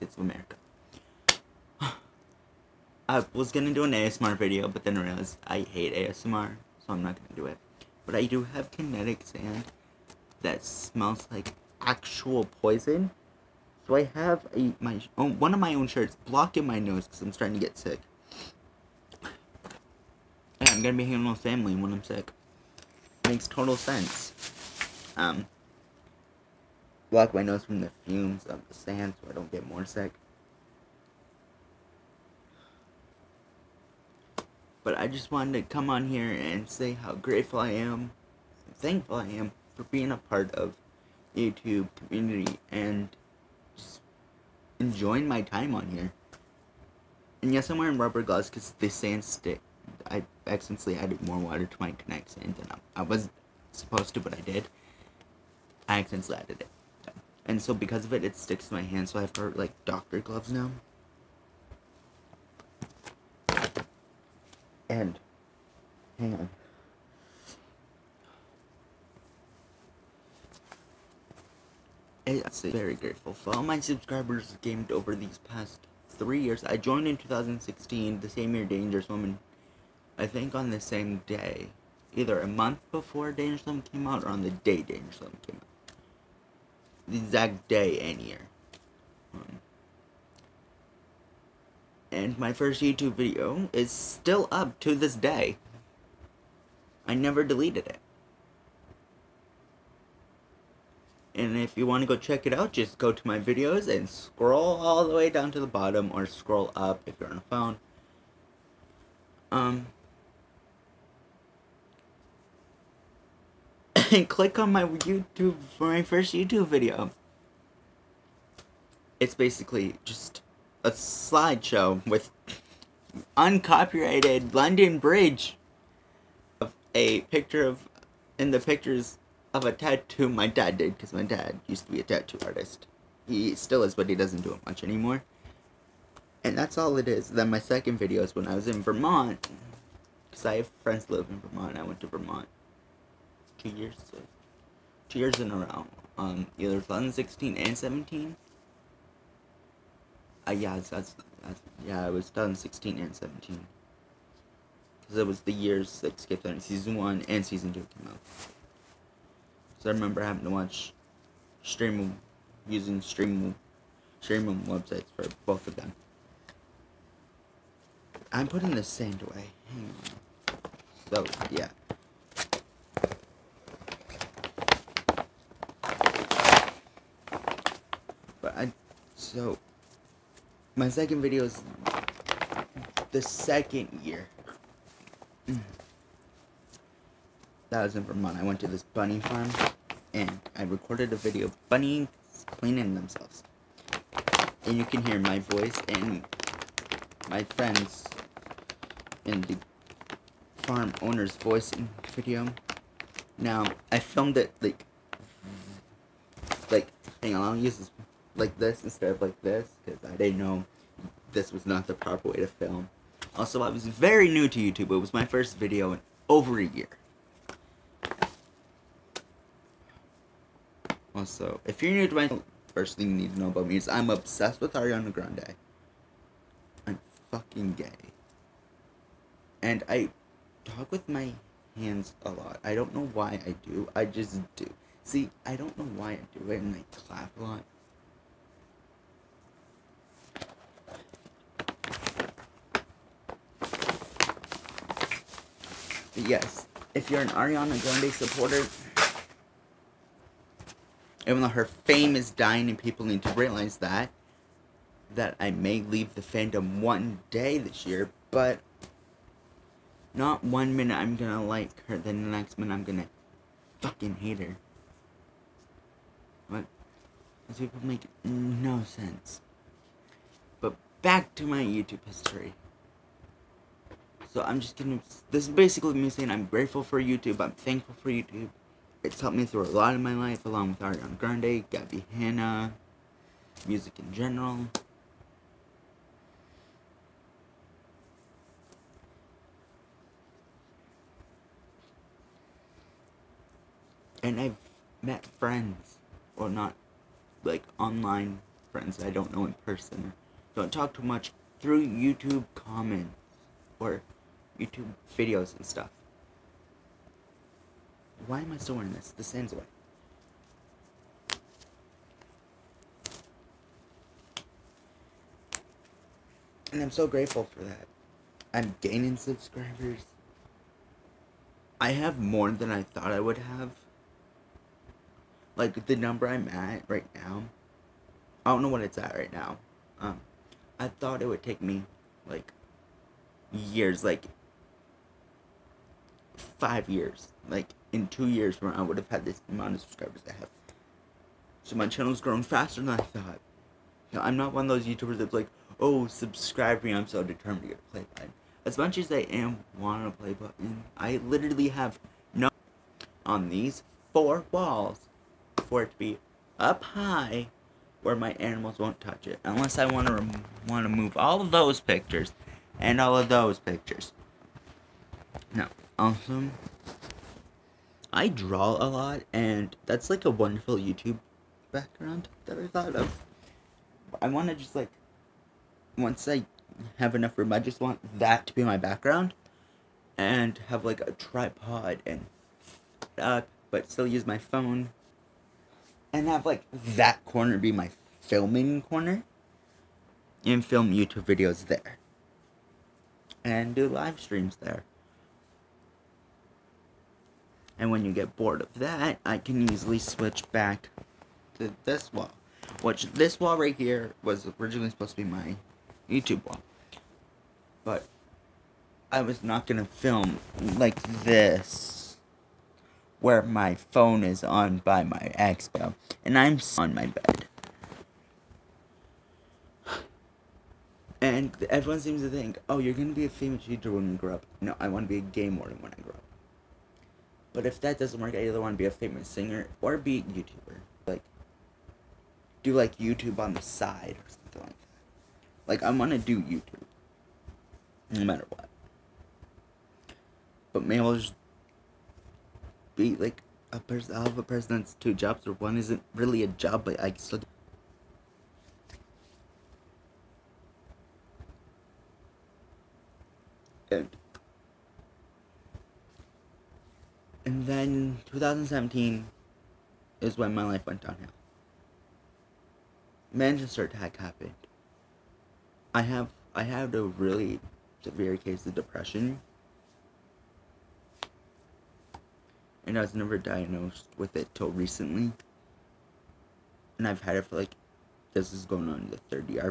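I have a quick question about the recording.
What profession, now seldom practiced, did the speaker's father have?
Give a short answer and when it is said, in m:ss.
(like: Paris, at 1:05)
tattoo artist, at 2:12.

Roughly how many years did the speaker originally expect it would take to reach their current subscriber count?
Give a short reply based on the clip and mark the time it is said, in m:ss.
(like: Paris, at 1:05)
5 years, at 5:36.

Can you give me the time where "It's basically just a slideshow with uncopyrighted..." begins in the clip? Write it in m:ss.
1:59.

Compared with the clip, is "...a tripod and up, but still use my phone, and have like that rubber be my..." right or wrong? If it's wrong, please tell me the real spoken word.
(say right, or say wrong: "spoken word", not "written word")
wrong: "corner", not "rubber".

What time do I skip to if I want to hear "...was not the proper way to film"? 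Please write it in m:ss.
3:31.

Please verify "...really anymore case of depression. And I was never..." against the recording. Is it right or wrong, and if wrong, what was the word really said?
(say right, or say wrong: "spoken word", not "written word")
wrong: "severe", not "anymore".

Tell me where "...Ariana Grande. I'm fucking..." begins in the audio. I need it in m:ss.
3:44.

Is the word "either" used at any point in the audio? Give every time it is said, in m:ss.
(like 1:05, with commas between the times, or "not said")
1:22, 2:26, 7:08.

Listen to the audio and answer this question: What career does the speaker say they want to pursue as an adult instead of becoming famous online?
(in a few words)
game warden.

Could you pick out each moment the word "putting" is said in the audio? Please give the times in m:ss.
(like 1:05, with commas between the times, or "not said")
2:48.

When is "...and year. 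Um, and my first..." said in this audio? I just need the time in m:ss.
1:27.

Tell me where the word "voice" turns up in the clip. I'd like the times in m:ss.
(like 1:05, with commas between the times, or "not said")
3:15, 3:21.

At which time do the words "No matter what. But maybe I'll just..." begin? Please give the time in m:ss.
7:18.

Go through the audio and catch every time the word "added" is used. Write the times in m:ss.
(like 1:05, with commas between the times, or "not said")
0:50, 0:56.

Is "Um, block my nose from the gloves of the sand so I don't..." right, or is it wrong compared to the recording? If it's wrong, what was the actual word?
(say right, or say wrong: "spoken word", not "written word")
wrong: "fumes", not "gloves".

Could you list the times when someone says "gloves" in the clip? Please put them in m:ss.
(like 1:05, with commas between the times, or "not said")
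0:48, 1:00.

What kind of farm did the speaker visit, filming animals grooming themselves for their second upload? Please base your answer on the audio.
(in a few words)
bunny farm.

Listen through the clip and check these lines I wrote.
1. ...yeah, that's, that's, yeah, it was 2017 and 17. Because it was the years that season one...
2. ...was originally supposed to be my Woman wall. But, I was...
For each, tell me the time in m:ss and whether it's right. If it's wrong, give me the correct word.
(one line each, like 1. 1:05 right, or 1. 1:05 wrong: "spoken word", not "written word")
1. 2:30 wrong: "2016", not "2017"
2. 6:44 wrong: "YouTube", not "Woman".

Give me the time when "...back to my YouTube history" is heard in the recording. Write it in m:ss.
4:31.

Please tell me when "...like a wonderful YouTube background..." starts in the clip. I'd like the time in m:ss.
6:10.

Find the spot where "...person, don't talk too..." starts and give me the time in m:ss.
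4:59.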